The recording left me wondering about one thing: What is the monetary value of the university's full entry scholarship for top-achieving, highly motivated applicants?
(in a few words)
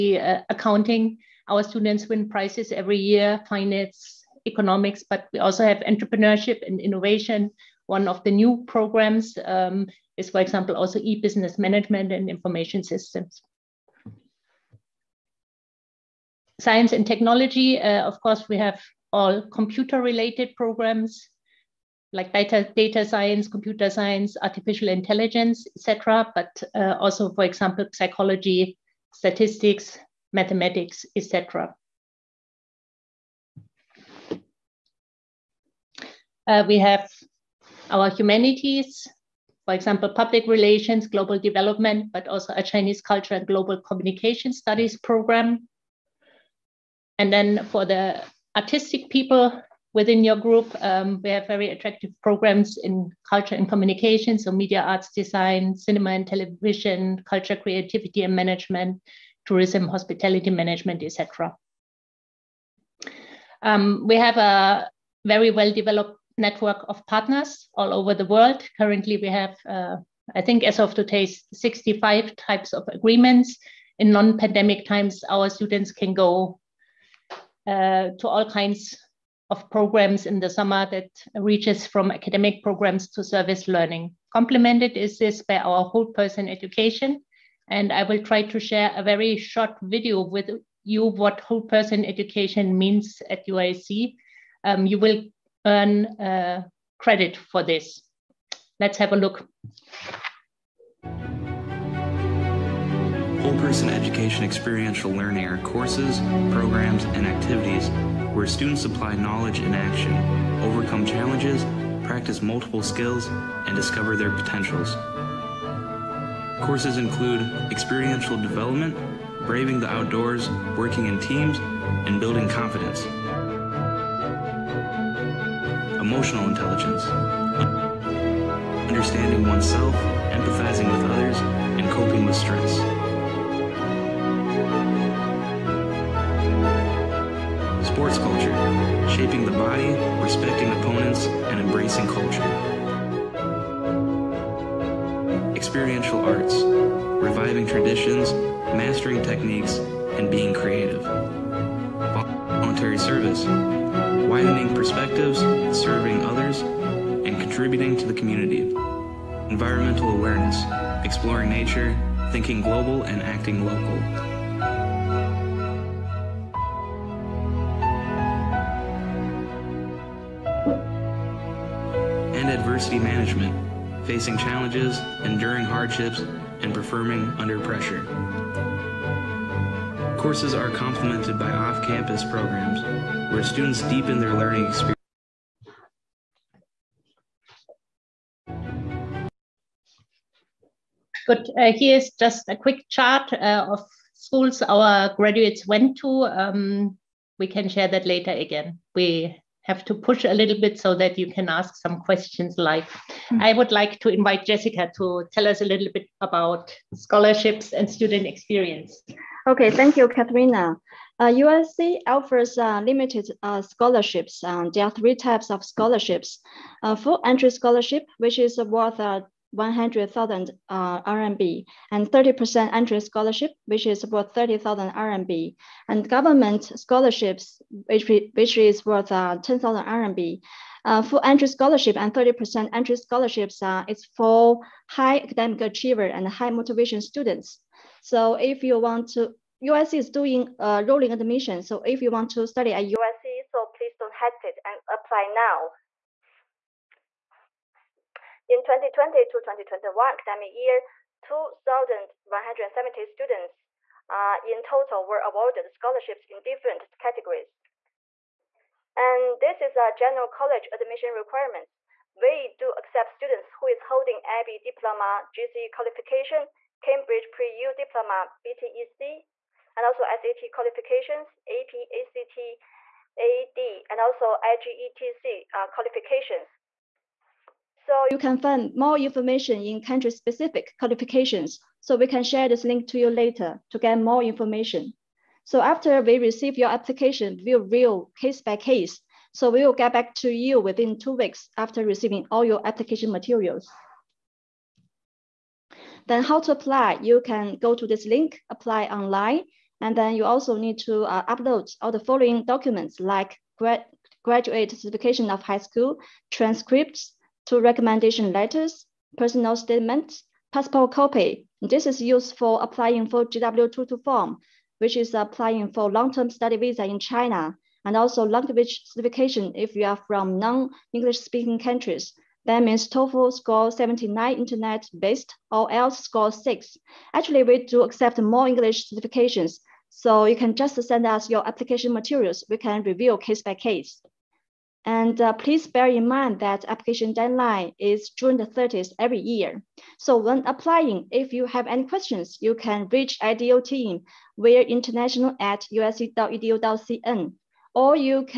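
100,000 RMB.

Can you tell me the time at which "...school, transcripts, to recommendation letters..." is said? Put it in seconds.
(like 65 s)
305 s.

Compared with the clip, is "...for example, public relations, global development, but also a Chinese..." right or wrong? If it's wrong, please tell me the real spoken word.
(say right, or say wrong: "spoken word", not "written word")
right.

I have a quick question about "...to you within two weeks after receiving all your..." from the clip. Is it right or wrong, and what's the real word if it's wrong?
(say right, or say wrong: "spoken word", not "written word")
right.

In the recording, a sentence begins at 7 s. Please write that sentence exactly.
One of the new programs um, is, for example, also e-business management and information systems.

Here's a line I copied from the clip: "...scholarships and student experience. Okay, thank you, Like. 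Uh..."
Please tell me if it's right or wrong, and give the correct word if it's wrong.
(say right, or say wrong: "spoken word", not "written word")
wrong: "Katharina", not "Like".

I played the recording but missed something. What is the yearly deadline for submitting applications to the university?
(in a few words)
June 30.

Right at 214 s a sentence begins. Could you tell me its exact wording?
Um, there are three types of scholarships.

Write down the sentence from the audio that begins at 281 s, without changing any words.
So we can share this link to you later to get more information.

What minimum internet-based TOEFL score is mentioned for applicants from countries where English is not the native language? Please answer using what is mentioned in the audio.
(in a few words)
79.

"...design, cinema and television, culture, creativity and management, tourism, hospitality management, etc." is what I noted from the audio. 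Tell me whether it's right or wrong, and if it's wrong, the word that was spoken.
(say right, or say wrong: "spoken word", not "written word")
right.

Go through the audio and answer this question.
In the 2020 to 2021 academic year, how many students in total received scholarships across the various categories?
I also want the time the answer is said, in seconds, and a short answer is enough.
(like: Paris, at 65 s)
2,170, at 251 s.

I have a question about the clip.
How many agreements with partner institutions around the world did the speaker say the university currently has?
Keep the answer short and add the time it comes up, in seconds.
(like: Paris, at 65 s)
65, at 71 s.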